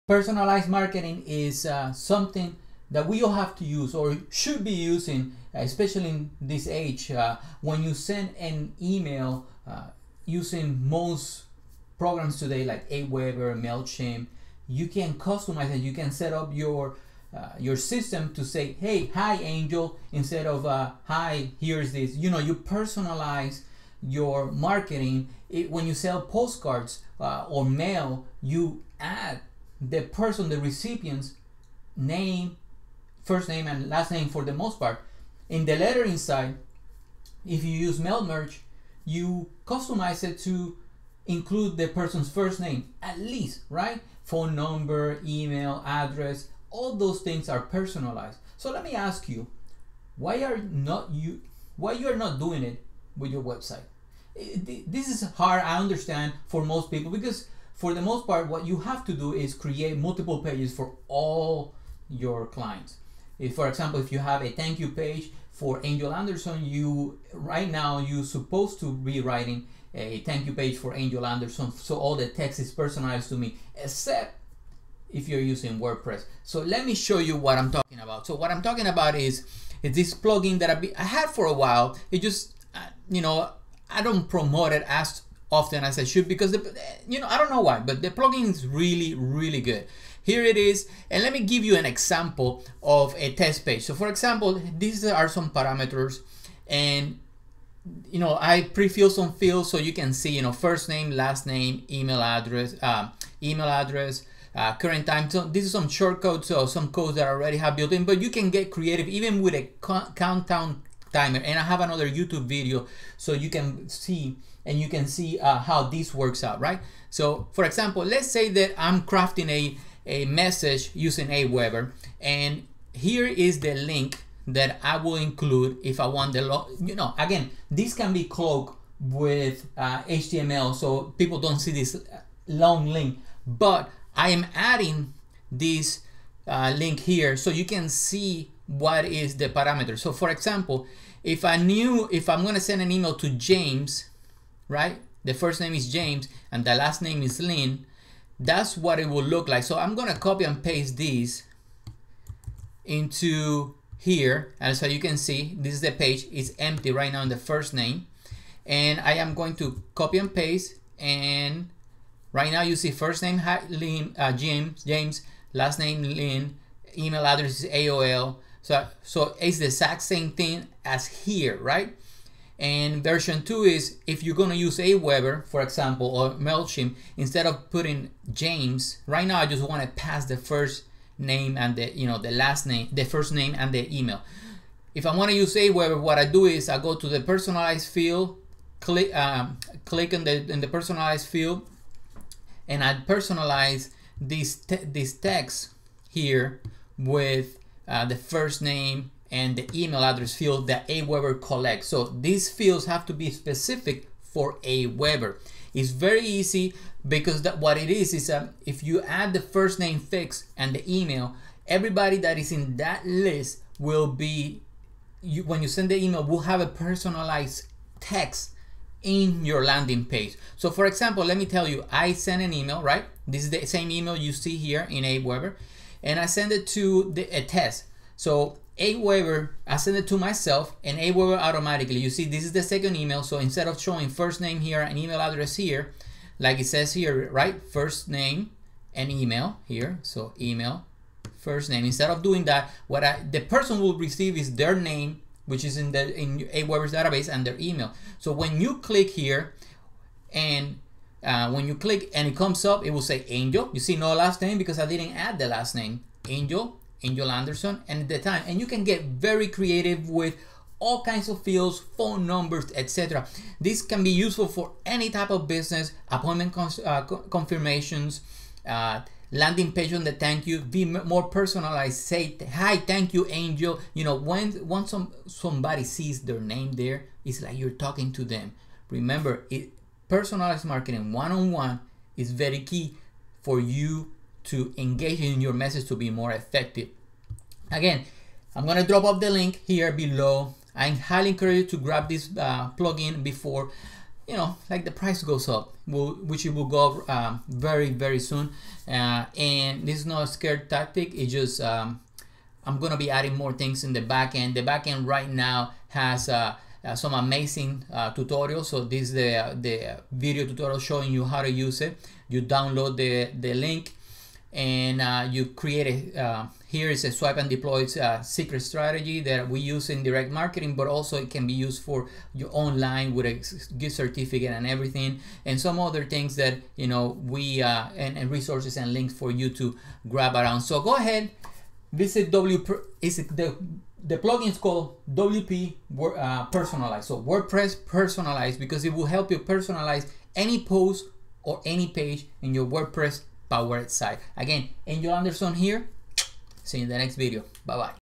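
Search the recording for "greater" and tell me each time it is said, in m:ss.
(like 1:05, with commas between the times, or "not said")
not said.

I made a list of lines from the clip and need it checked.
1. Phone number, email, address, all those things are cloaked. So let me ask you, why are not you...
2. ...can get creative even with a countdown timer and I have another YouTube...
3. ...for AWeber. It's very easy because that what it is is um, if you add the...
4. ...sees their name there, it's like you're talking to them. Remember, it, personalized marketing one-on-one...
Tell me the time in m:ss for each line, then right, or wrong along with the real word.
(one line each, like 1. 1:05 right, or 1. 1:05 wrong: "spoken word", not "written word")
1. 0:44 wrong: "personalized", not "cloaked"
2. 1:48 right
3. 3:24 right
4. 4:35 right.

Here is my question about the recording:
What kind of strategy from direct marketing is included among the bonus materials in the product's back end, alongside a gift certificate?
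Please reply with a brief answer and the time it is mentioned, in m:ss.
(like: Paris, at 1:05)
swipe and deploy, at 5:17.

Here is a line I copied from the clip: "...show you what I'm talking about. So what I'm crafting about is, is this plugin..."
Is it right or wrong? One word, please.
wrong.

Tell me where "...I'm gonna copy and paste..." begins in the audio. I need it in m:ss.
2:29.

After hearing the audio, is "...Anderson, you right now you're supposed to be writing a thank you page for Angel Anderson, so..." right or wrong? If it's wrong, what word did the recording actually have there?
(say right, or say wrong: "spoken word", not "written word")
right.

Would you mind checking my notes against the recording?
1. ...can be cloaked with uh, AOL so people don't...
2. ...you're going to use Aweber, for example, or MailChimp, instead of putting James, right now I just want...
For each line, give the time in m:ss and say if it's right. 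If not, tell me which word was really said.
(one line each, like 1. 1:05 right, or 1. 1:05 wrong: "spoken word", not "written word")
1. 2:07 wrong: "HTML", not "AOL"
2. 2:54 right.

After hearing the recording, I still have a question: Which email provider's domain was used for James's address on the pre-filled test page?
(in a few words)
AOL.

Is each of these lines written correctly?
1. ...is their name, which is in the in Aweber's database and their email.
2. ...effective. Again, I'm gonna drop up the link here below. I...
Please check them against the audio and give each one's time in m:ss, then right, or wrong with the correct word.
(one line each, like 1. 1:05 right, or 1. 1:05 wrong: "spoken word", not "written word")
1. 4:04 right
2. 4:46 right.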